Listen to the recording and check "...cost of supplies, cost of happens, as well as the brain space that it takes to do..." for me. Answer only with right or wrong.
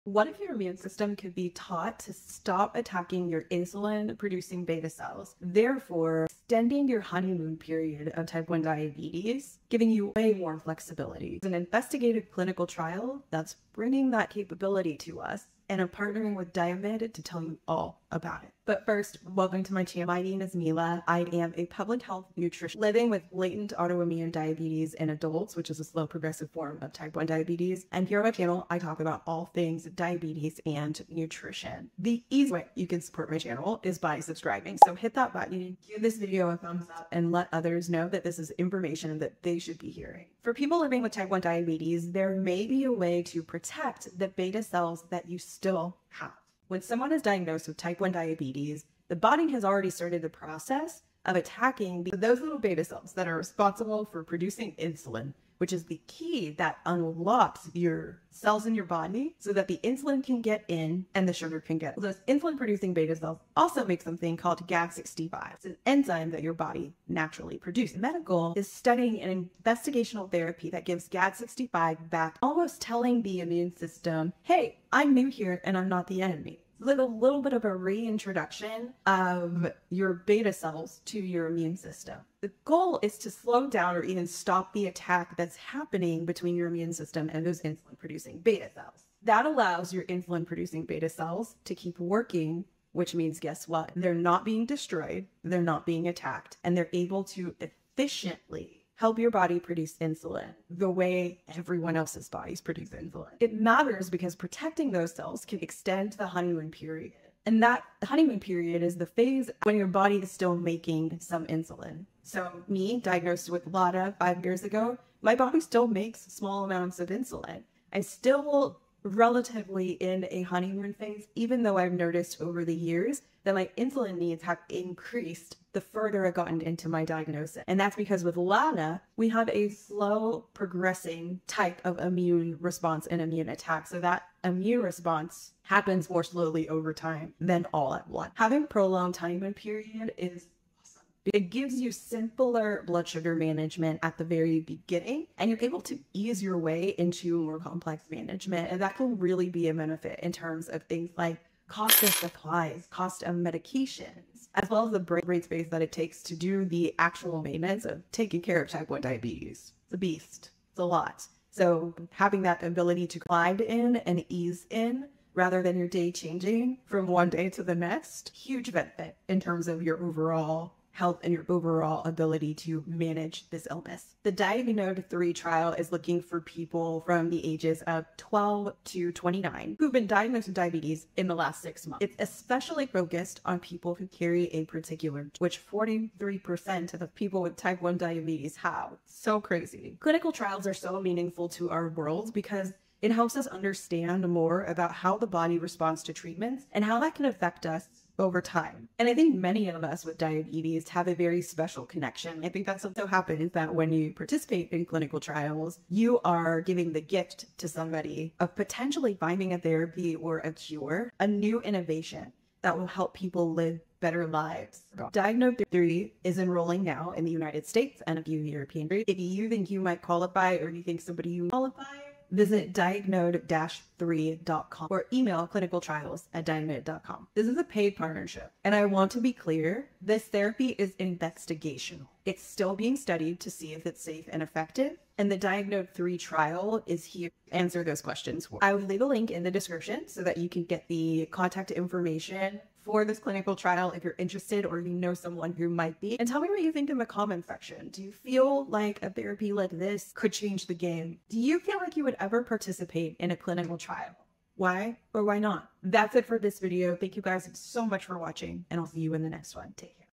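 wrong.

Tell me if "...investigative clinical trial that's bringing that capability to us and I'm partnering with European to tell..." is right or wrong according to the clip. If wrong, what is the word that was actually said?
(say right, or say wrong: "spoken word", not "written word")
wrong: "Diamyd", not "European".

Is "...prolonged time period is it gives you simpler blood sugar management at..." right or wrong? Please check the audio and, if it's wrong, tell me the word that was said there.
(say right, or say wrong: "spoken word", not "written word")
right.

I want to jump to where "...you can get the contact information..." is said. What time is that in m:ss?
4:00.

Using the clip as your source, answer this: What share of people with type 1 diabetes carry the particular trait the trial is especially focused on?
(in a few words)
43%.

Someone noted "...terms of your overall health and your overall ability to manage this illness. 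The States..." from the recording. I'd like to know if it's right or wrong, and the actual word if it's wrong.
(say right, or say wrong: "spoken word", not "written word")
wrong: "Diagnode", not "States".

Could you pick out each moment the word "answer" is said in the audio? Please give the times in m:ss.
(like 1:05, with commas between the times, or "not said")
3:57.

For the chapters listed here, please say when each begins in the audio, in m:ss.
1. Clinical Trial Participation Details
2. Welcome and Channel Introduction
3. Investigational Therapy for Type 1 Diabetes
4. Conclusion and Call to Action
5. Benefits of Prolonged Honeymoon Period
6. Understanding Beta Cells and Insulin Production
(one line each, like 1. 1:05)
1. 2:54
2. 0:18
3. 1:07
4. 4:15
5. 1:43
6. 0:40.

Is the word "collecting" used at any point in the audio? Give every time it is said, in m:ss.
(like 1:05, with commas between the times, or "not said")
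not said.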